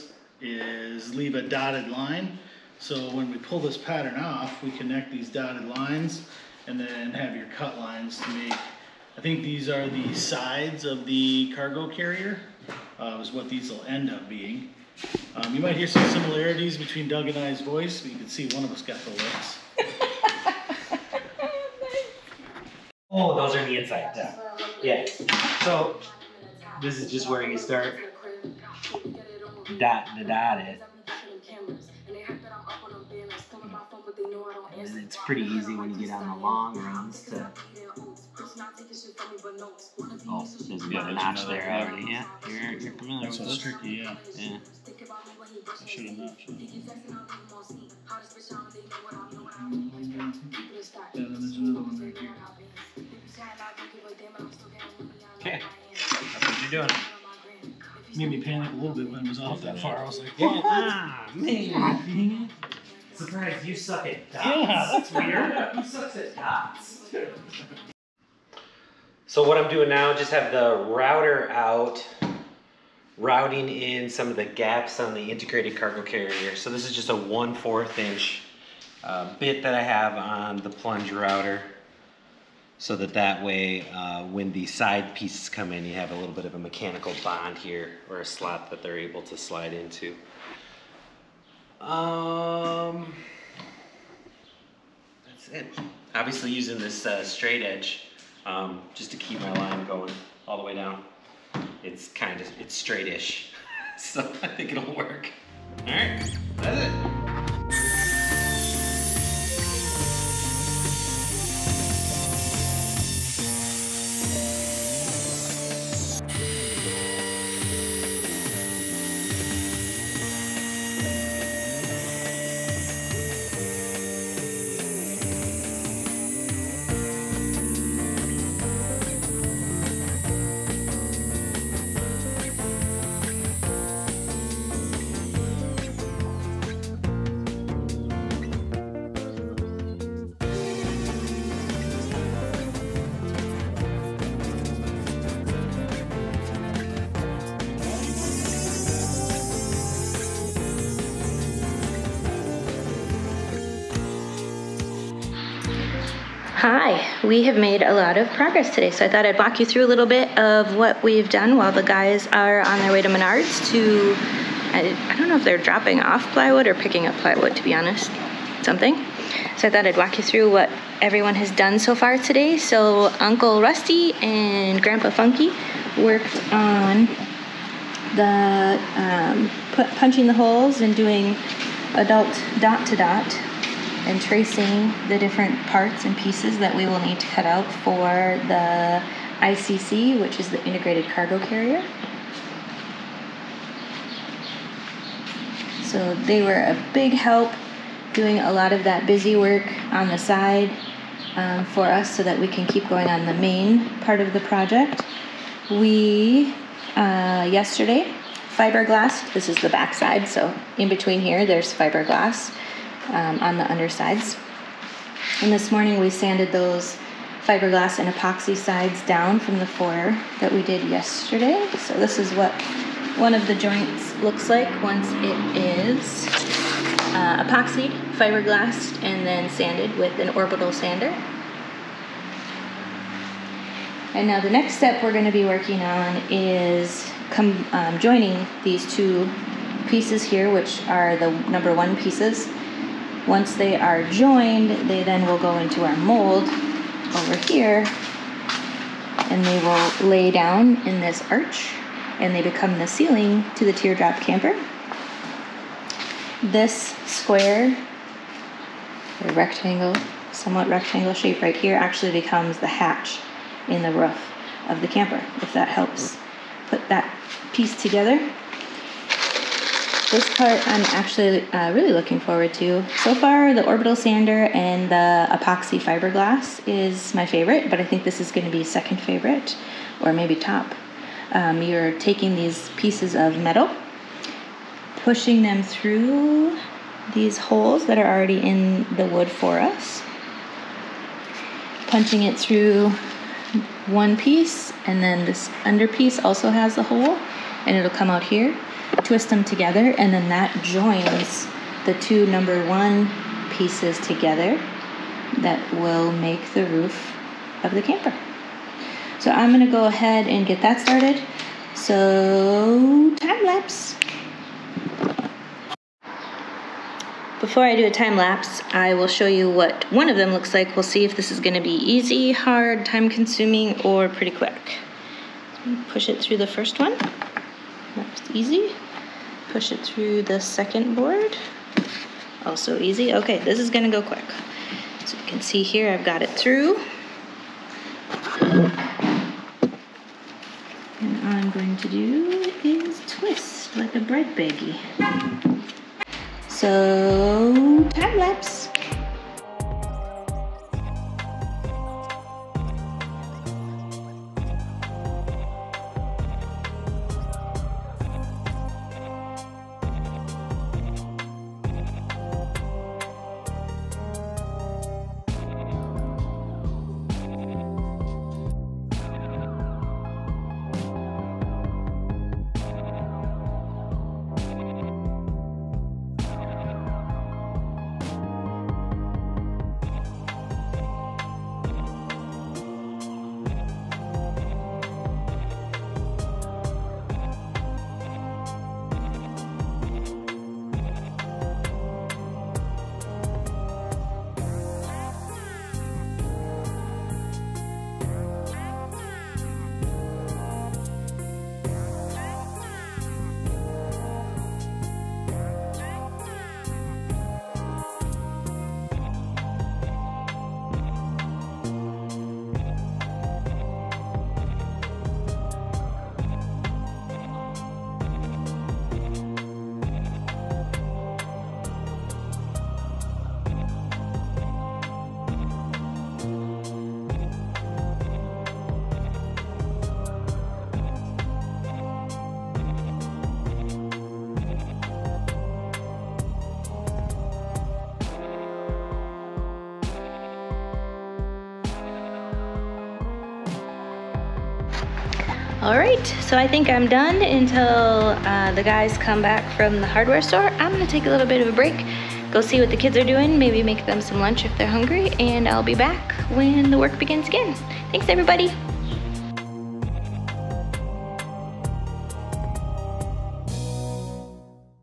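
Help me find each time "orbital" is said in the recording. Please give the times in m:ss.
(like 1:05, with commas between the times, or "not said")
3:50, 4:33.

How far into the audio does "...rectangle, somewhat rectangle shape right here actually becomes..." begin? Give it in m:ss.
4:19.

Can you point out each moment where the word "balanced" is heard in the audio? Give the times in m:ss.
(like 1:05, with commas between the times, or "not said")
not said.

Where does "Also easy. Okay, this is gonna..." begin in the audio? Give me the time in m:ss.
5:32.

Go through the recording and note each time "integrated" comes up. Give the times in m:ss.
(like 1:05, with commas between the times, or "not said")
1:15, 3:10.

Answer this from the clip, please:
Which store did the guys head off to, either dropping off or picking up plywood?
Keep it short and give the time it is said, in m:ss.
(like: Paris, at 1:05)
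Menards, at 2:43.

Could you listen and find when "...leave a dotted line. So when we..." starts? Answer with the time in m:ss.
0:01.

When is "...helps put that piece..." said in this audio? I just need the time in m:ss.
4:25.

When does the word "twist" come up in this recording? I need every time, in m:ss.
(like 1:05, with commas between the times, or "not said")
4:59, 5:43.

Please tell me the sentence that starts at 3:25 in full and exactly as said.
We, uh, yesterday, fiberglass, this is the backside, so in between here there's fiberglass um, on the undersides.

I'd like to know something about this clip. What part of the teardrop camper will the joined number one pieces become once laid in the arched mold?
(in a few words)
The ceiling.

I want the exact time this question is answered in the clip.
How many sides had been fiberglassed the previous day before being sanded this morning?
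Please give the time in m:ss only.
3:39.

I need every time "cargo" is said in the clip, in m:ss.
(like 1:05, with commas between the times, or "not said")
0:11, 1:15, 3:11.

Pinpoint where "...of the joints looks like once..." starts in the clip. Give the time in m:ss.
3:43.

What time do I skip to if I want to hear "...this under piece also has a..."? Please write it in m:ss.
4:55.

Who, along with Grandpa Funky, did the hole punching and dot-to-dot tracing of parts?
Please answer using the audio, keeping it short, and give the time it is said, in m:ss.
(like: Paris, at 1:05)
Uncle Rusty, at 2:53.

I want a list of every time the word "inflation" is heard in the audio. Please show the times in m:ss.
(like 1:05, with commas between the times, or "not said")
not said.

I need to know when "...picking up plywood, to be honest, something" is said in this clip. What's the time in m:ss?
2:46.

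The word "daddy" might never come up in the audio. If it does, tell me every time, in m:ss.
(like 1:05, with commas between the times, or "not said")
not said.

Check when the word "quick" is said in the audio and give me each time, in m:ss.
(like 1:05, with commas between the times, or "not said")
5:24, 5:34.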